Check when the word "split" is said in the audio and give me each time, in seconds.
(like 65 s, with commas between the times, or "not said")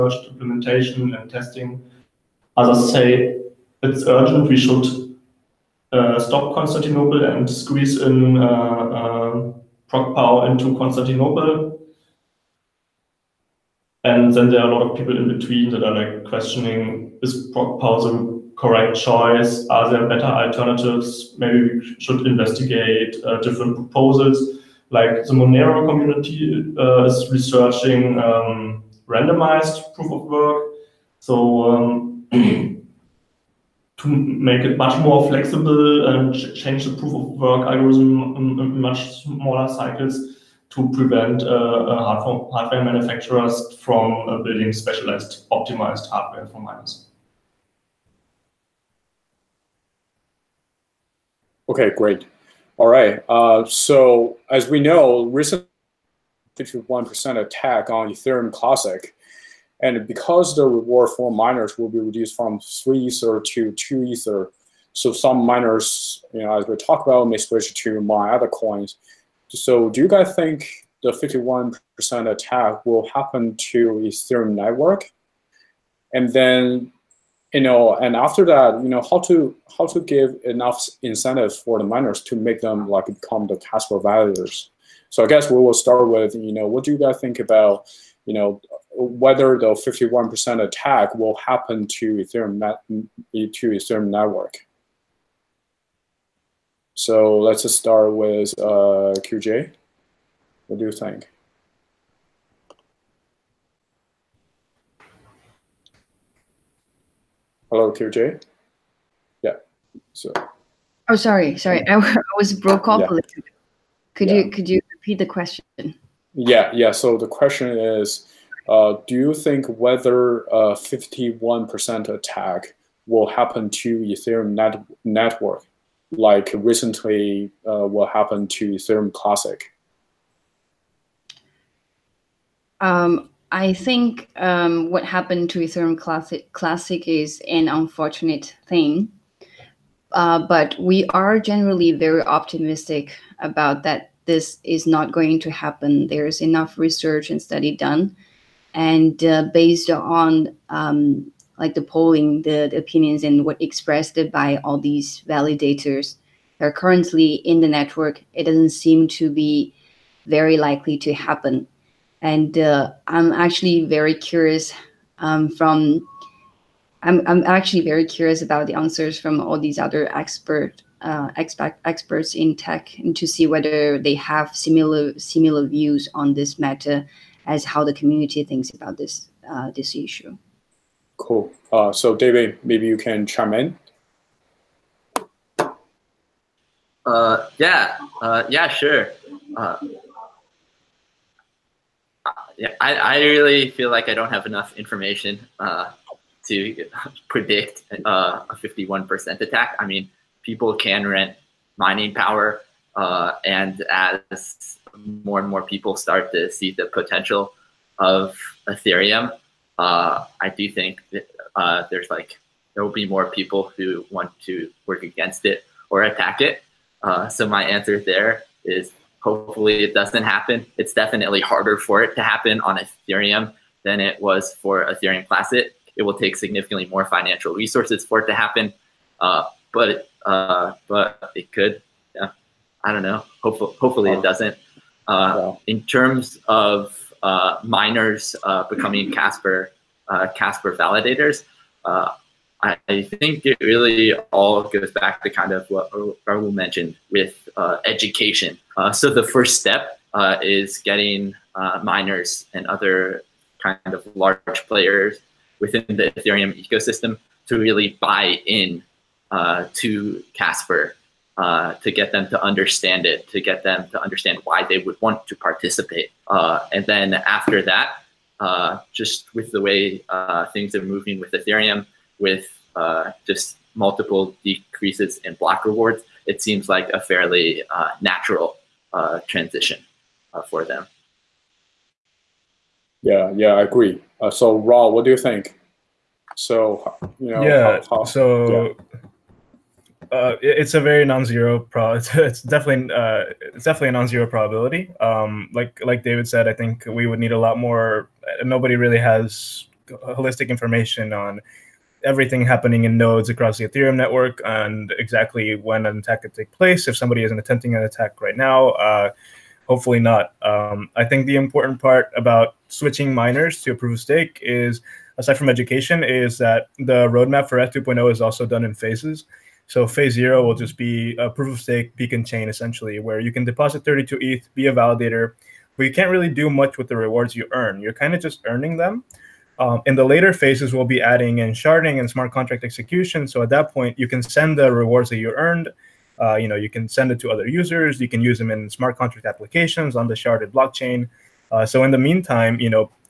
not said.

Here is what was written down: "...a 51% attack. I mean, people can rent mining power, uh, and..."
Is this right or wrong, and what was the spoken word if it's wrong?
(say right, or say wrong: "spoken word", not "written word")
right.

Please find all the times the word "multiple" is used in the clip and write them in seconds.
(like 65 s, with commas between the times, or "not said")
273 s.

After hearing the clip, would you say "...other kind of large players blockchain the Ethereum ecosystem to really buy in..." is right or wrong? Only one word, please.
wrong.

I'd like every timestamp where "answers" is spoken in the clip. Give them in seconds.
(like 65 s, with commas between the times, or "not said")
168 s, 217 s.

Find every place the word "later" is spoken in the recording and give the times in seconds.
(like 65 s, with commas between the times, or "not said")
330 s.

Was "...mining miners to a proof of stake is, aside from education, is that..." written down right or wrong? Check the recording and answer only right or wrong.
wrong.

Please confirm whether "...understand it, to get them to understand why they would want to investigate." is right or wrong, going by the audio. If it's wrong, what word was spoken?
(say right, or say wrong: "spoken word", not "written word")
wrong: "participate", not "investigate".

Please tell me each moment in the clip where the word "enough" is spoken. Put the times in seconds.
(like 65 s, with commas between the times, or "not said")
80 s, 146 s, 194 s.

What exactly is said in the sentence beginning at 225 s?
It will take significantly more financial resources for it to happen, uh, but uh, but it could.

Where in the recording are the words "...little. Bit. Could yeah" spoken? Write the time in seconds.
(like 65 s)
113 s.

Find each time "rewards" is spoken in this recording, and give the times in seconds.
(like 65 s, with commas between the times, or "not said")
60 s, 275 s, 326 s, 334 s.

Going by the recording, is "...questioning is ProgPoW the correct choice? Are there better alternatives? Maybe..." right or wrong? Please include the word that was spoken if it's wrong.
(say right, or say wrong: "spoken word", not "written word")
right.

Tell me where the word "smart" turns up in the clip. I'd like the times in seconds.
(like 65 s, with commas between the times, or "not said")
332 s, 338 s.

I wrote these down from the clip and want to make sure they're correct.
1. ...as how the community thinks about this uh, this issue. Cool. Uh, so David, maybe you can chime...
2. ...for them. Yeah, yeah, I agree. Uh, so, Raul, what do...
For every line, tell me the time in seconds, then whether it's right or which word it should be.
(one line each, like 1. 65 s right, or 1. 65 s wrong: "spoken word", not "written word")
1. 177 s right
2. 280 s right.